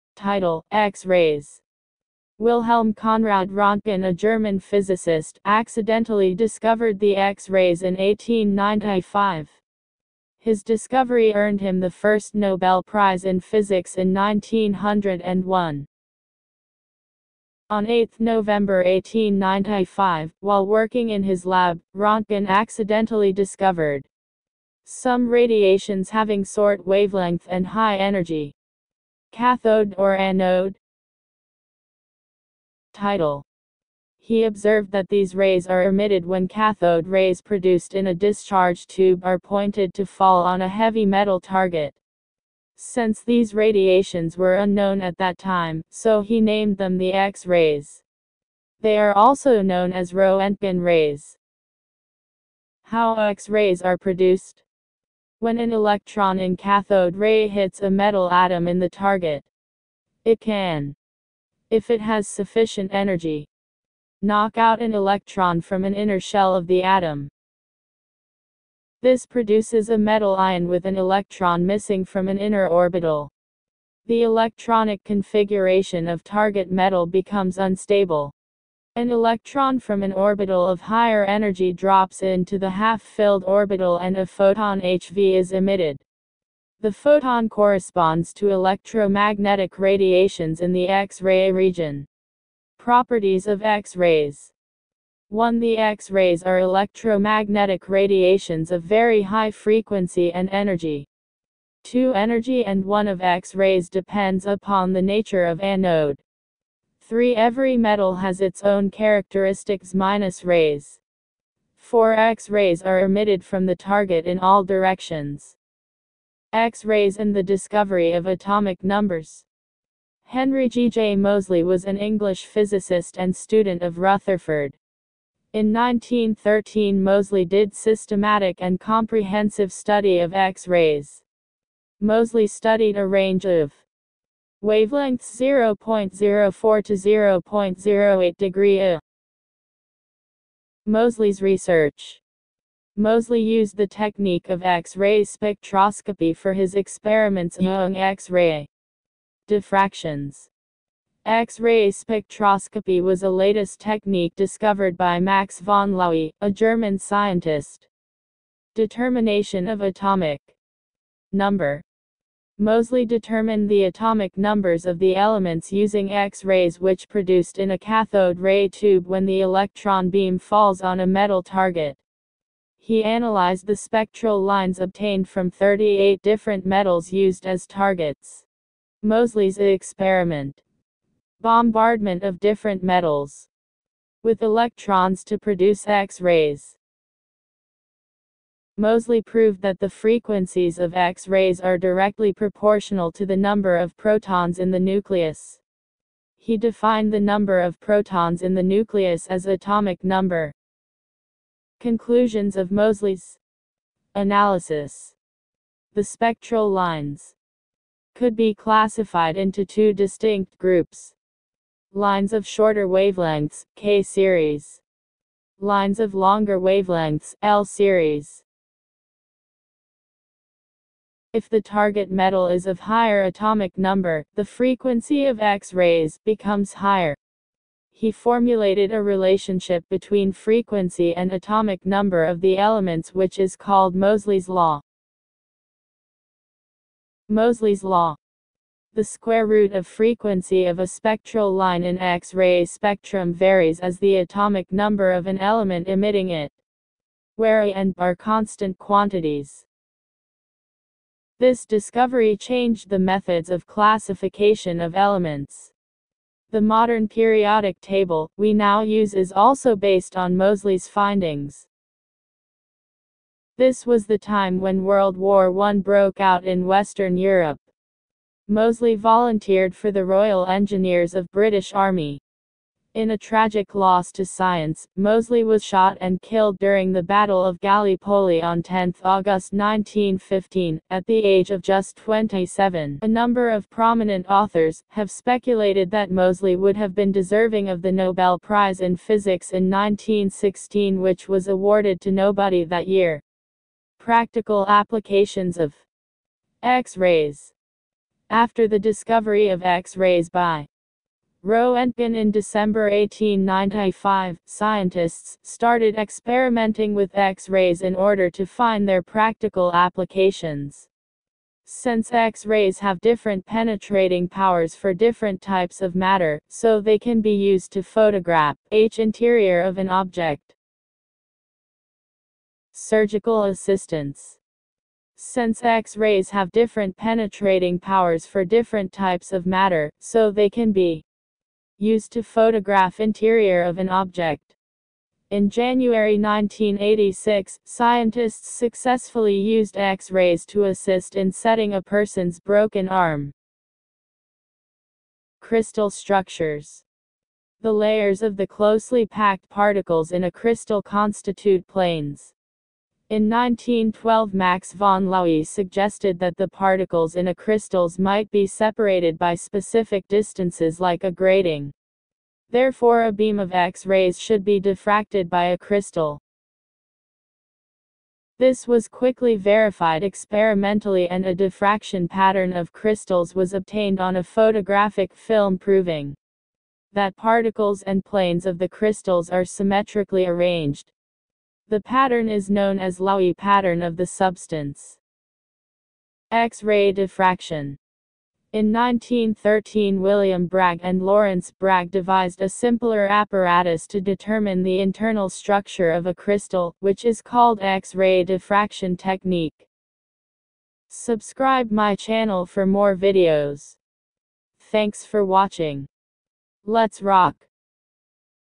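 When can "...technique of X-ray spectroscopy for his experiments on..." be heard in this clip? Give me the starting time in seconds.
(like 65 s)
143 s.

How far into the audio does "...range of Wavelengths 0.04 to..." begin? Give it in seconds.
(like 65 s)
133 s.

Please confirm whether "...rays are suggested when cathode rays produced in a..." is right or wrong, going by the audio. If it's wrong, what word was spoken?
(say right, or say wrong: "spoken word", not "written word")
wrong: "emitted", not "suggested".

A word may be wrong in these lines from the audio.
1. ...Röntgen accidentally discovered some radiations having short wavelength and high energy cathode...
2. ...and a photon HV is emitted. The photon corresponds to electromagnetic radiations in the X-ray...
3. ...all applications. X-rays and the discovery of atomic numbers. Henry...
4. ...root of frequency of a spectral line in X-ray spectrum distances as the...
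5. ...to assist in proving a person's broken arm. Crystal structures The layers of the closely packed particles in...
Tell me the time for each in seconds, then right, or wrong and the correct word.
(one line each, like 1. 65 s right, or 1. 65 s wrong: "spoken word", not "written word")
1. 21 s right
2. 83 s right
3. 114 s wrong: "directions", not "applications"
4. 239 s wrong: "varies", not "distances"
5. 340 s wrong: "setting", not "proving".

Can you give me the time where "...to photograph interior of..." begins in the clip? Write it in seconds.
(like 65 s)
332 s.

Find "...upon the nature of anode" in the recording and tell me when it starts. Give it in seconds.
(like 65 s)
104 s.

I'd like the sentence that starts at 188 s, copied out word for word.
Moseley proved that the frequencies of X-rays are directly proportional to the number of protons in the nucleus.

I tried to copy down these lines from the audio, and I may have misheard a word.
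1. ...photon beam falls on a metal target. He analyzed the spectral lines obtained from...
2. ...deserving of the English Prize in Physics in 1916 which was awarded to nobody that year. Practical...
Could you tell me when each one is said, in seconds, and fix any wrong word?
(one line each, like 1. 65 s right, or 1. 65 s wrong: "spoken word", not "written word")
1. 169 s wrong: "electron", not "photon"
2. 287 s wrong: "Nobel", not "English".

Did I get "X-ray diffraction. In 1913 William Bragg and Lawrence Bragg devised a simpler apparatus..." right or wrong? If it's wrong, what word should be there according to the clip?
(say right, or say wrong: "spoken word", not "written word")
right.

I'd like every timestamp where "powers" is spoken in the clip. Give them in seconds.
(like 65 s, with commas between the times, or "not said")
314 s, 327 s.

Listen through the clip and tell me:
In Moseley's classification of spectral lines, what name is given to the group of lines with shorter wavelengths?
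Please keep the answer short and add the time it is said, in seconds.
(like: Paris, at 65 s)
K series, at 213 s.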